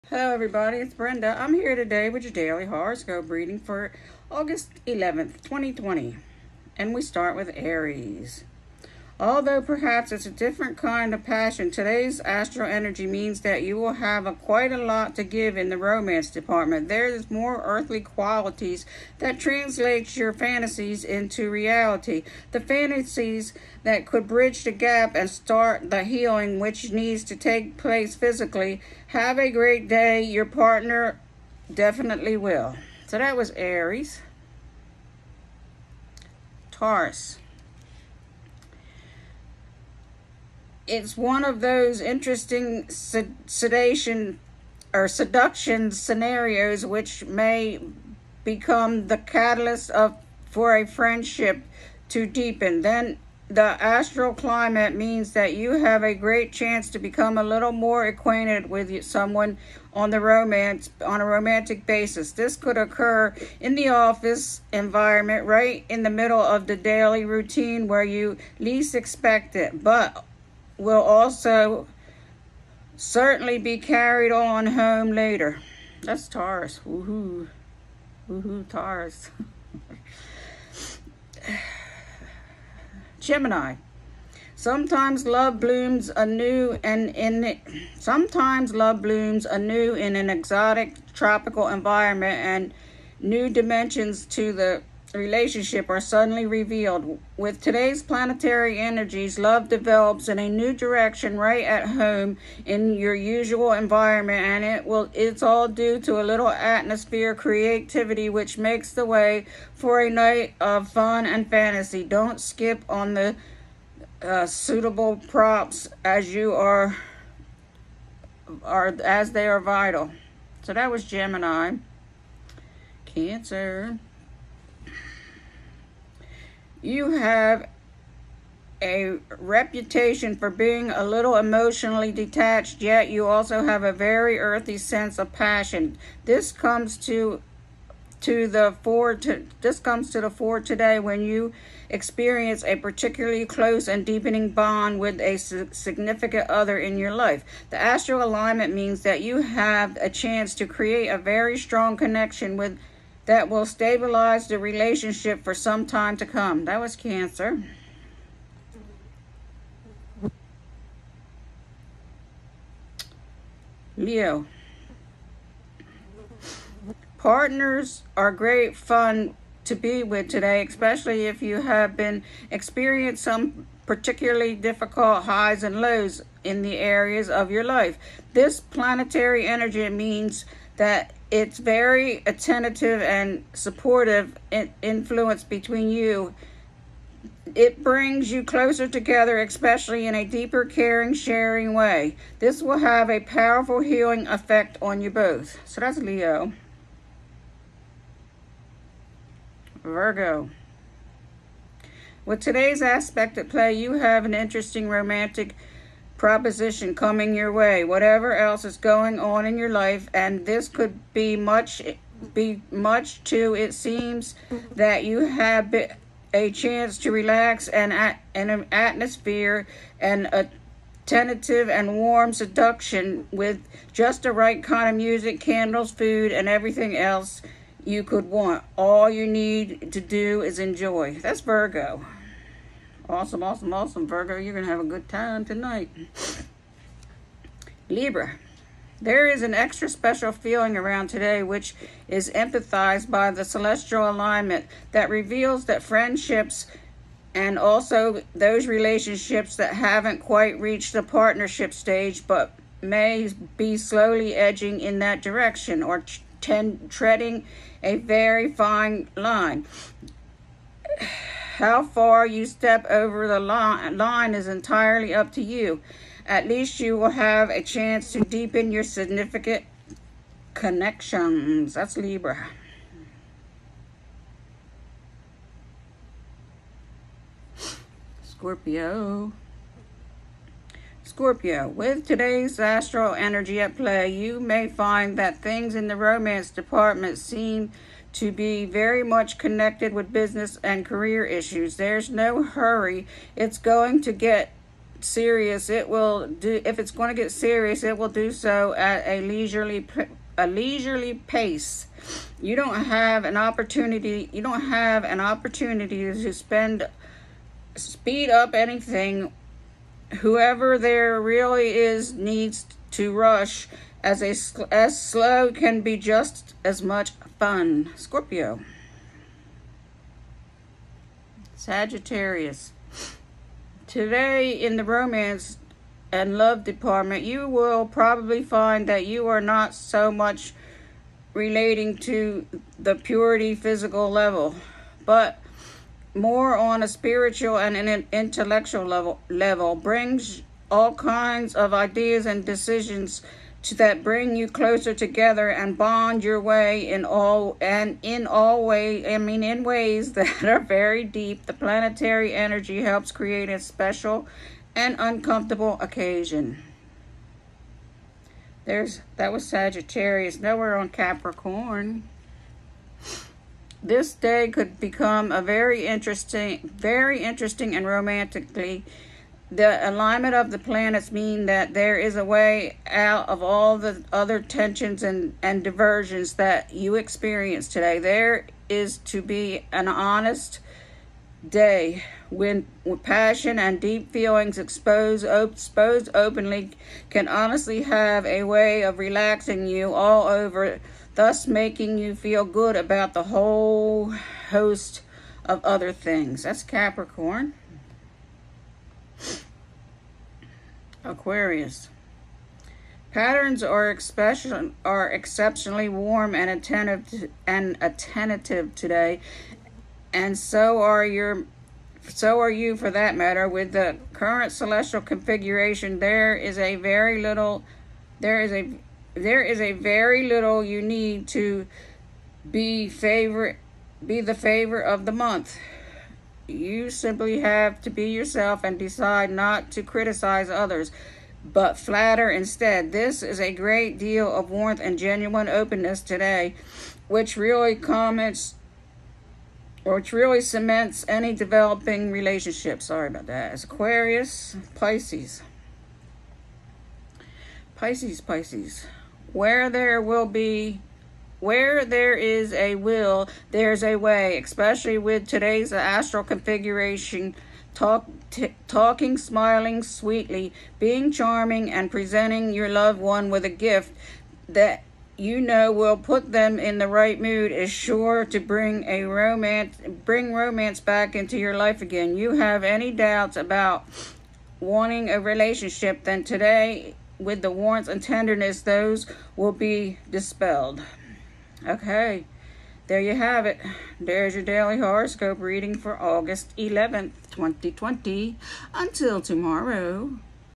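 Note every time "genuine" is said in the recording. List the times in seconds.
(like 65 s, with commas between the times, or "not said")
434 s.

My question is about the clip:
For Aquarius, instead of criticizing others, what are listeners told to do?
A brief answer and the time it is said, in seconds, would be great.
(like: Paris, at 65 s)
flatter, at 431 s.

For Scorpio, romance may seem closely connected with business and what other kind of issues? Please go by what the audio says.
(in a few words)
career.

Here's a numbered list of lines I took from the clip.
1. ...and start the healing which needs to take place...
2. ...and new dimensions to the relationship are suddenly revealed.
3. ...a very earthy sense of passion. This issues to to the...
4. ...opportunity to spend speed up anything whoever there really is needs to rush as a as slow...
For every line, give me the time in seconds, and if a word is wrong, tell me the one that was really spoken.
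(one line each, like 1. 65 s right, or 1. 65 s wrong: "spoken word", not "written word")
1. 25 s right
2. 92 s right
3. 133 s wrong: "comes", not "issues"
4. 305 s right.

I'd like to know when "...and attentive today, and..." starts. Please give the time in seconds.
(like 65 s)
407 s.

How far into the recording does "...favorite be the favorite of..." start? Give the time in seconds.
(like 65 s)
422 s.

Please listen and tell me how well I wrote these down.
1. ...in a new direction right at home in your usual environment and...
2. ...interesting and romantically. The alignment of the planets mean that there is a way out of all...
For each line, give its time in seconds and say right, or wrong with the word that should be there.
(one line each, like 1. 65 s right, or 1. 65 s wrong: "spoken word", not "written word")
1. 100 s right
2. 367 s right.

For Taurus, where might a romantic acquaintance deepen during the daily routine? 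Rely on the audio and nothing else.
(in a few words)
office environment.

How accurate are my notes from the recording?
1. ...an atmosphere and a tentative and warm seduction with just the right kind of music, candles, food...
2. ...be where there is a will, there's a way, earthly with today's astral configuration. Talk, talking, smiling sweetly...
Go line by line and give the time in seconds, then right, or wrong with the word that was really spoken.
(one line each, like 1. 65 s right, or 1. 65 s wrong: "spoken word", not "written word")
1. 218 s right
2. 450 s wrong: "especially", not "earthly".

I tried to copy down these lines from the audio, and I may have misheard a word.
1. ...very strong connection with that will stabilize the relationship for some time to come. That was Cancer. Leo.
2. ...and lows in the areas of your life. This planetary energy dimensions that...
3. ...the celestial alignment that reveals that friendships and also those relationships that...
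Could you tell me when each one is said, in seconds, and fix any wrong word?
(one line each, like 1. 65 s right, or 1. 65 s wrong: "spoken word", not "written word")
1. 151 s right
2. 175 s wrong: "means", not "dimensions"
3. 243 s right.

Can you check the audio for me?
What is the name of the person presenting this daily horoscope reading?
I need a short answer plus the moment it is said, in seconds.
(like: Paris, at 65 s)
Brenda, at 0 s.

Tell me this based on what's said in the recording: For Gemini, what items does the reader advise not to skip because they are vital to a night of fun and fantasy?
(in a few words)
suitable props.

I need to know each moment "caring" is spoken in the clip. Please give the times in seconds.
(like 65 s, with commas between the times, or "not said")
190 s.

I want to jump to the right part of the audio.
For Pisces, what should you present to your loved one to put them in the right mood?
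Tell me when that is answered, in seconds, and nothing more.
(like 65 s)
463 s.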